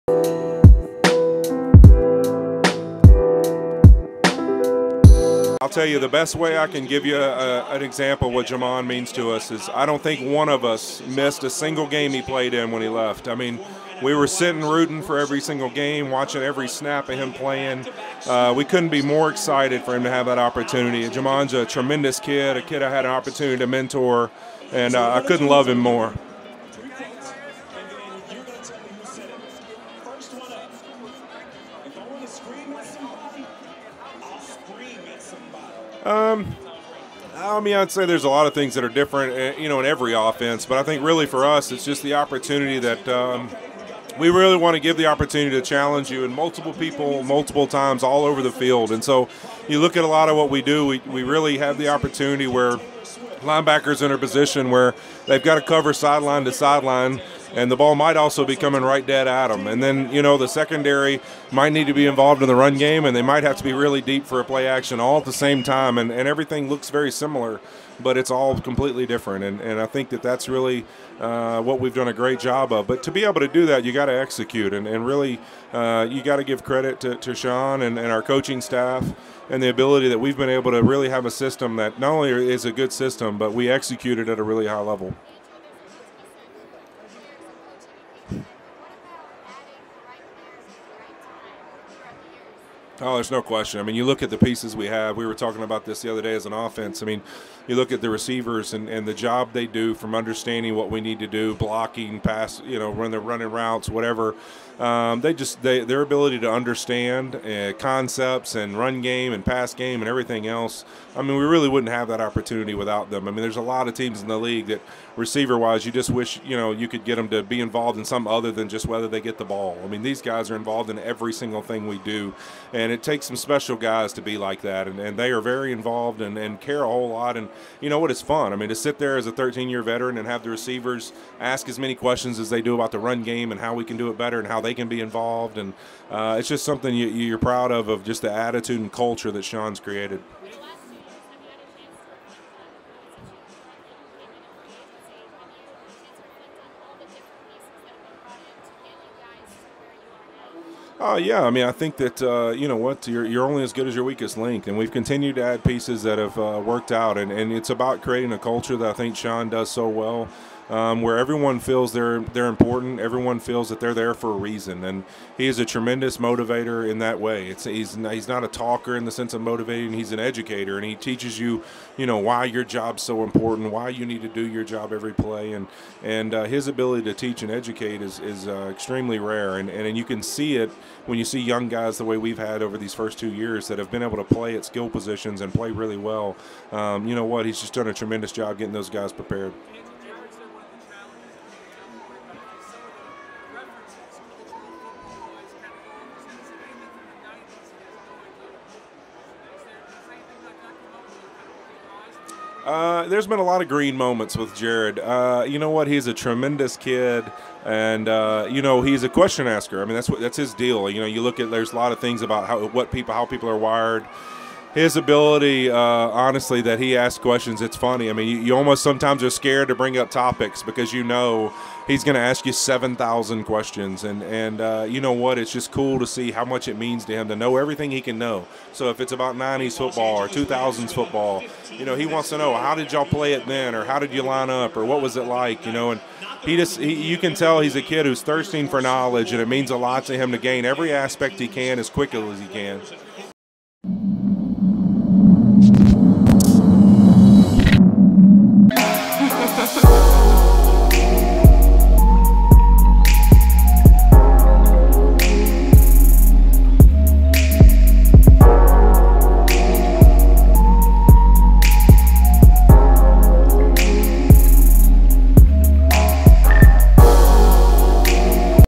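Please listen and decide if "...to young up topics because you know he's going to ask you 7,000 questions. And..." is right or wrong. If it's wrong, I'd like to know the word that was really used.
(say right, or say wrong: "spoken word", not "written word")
wrong: "bring", not "young".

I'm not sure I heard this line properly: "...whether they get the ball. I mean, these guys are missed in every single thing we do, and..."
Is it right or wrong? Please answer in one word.
wrong.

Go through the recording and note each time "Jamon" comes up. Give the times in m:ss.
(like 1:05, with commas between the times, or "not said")
0:08, 0:21.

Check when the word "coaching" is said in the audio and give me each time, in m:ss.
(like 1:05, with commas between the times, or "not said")
1:18.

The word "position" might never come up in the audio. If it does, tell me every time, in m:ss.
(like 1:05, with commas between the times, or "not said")
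0:54, 3:04.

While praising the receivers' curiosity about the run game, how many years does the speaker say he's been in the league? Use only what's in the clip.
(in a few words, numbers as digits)
13.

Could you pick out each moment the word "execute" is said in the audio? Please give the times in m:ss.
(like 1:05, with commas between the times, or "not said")
1:14, 1:23.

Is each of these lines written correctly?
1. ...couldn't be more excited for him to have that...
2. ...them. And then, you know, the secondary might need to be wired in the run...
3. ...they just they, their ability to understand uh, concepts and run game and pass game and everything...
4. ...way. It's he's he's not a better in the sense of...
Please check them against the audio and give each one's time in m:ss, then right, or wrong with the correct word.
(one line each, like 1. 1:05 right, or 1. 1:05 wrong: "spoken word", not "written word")
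1. 0:18 right
2. 0:59 wrong: "involved", not "wired"
3. 1:45 right
4. 2:47 wrong: "talker", not "better".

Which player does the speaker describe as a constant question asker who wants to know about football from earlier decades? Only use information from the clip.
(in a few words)
Jared.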